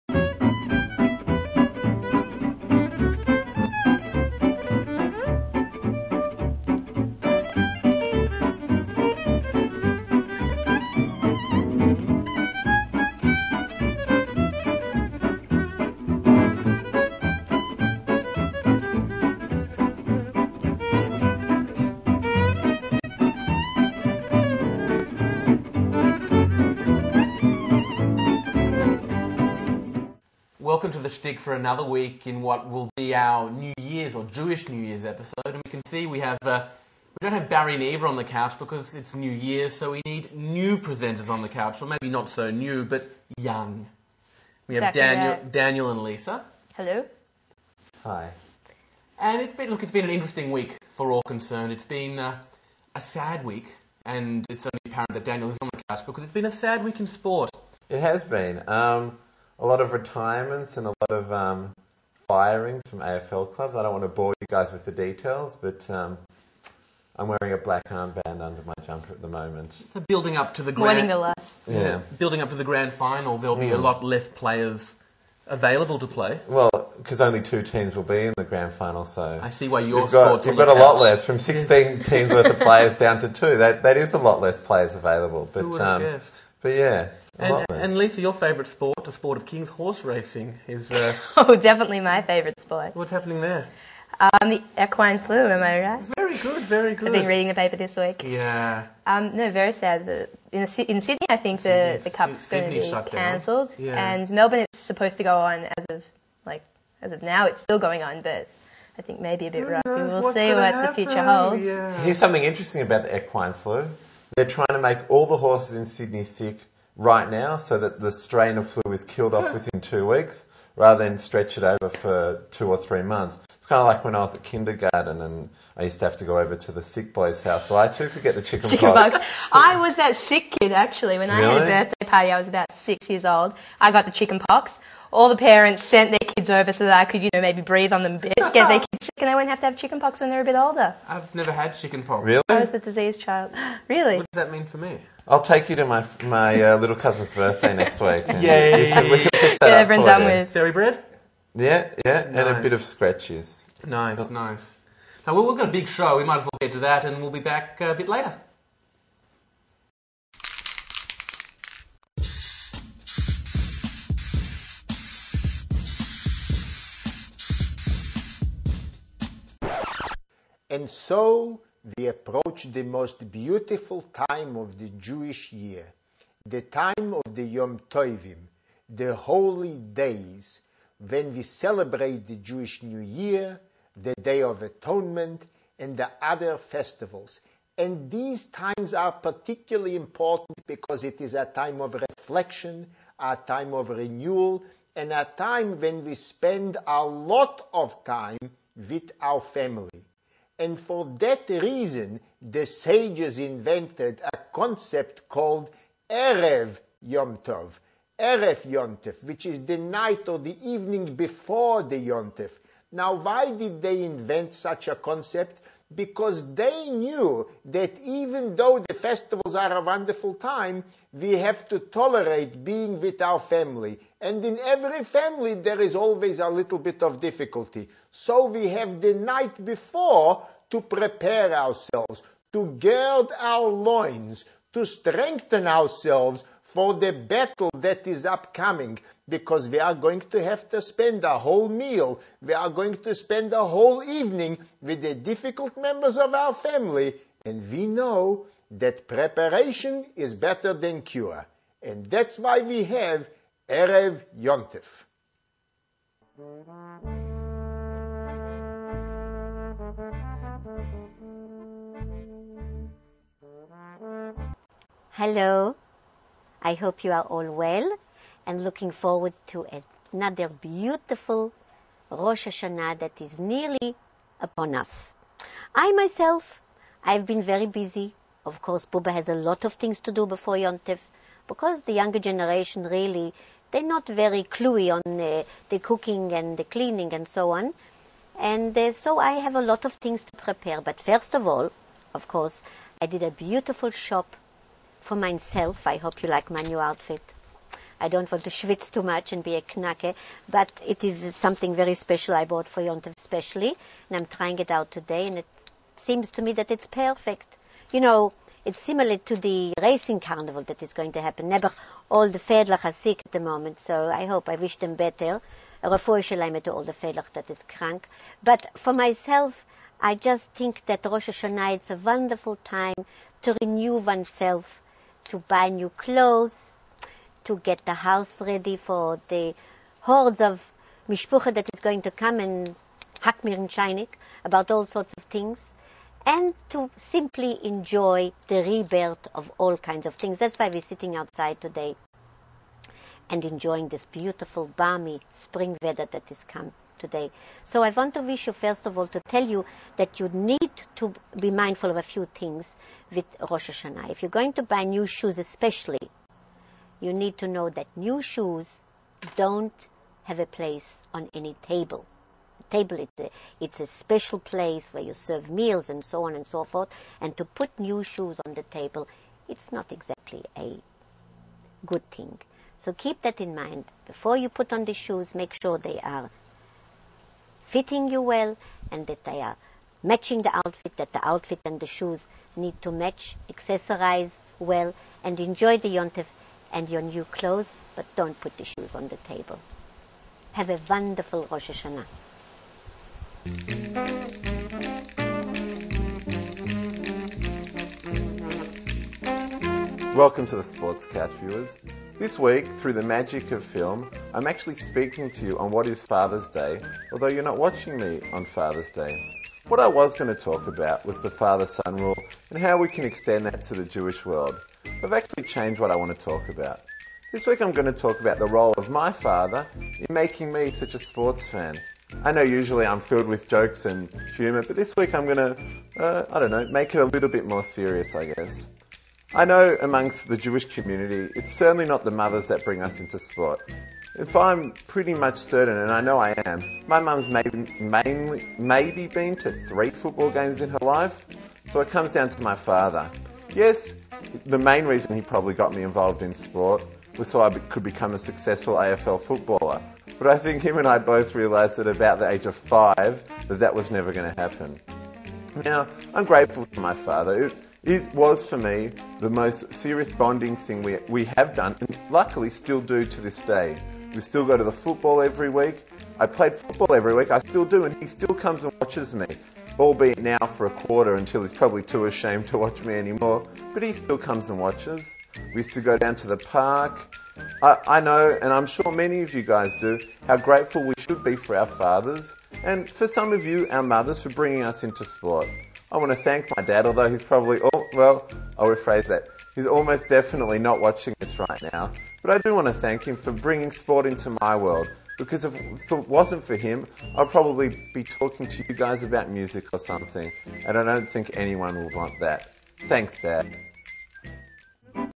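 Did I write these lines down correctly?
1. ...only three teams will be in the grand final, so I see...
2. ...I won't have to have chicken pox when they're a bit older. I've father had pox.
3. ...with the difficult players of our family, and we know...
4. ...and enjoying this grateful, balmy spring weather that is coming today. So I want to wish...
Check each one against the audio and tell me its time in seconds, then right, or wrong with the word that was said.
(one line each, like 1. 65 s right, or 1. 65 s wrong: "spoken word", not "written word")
1. 77 s wrong: "two", not "three"
2. 139 s wrong: "never", not "father"
3. 244 s wrong: "members", not "players"
4. 343 s wrong: "beautiful", not "grateful".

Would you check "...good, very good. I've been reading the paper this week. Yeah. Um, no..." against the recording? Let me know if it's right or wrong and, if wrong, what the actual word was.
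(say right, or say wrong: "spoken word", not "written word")
right.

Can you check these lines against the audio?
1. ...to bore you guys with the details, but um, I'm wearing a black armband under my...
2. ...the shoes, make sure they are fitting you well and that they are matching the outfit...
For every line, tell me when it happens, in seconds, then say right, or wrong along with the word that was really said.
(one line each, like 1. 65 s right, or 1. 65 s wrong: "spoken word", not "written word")
1. 64 s right
2. 374 s right.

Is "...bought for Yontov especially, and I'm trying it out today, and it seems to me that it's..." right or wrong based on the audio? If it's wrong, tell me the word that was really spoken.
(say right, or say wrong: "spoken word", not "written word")
right.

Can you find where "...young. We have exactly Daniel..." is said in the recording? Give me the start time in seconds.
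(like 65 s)
43 s.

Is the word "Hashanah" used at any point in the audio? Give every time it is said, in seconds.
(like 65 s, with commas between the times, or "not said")
272 s, 321 s, 353 s, 391 s.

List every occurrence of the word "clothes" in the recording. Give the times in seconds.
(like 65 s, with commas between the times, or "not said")
325 s, 387 s.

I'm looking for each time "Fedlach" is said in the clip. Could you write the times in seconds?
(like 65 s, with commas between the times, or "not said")
312 s, 316 s.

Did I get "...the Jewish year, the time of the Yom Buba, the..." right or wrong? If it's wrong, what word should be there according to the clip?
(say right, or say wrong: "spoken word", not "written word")
wrong: "Tovim", not "Buba".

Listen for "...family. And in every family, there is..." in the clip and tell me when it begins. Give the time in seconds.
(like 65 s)
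223 s.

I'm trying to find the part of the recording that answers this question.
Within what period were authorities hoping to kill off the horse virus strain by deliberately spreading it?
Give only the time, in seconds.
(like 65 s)
119 s.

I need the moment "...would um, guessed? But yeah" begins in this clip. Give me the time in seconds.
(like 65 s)
85 s.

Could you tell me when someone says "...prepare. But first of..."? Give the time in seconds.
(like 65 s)
290 s.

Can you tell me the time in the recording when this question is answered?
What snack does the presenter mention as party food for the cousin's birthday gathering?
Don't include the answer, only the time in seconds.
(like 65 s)
150 s.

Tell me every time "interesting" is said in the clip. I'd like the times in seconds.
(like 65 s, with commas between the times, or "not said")
50 s, 112 s.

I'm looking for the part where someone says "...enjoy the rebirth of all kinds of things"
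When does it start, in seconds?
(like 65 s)
337 s.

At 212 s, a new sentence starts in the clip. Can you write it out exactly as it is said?
Now, why did they invent such a concept?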